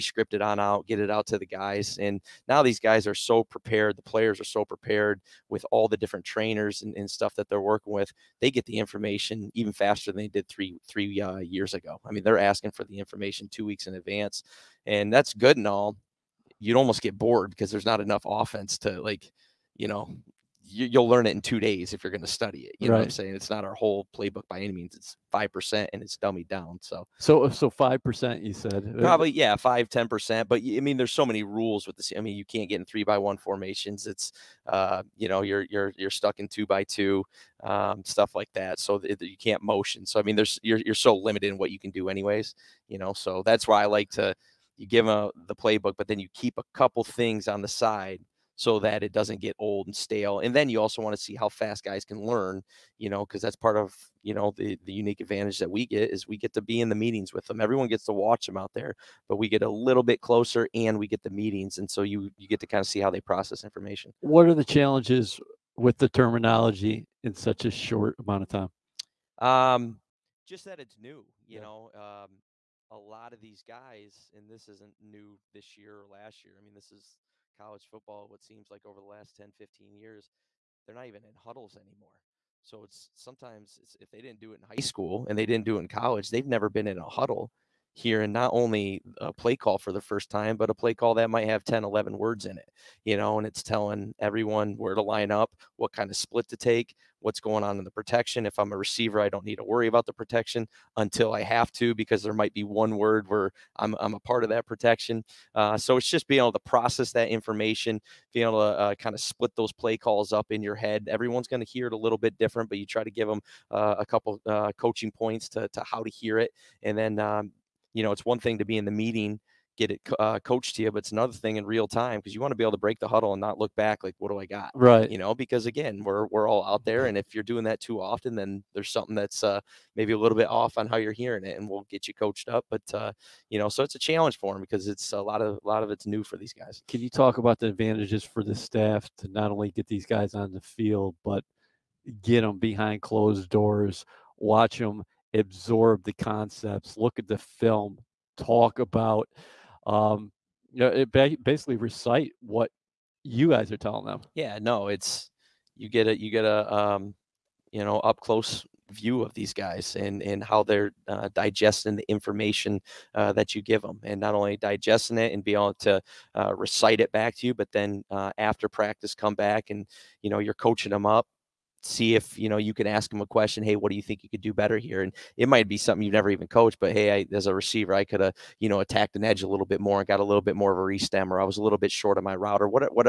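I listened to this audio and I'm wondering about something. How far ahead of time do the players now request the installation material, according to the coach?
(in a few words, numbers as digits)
2 weeks.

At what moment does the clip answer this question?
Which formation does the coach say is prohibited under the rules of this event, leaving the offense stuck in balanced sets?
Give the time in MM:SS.
00:32.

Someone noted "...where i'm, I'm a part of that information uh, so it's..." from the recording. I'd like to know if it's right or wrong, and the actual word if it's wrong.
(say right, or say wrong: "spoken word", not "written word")
wrong: "protection", not "information".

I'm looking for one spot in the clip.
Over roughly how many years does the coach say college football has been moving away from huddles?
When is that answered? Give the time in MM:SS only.
01:19.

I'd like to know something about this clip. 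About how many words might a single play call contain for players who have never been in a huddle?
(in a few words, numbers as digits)
10-11 words.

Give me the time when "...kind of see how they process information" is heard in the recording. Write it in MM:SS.
01:02.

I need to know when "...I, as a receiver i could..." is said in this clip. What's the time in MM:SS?
02:57.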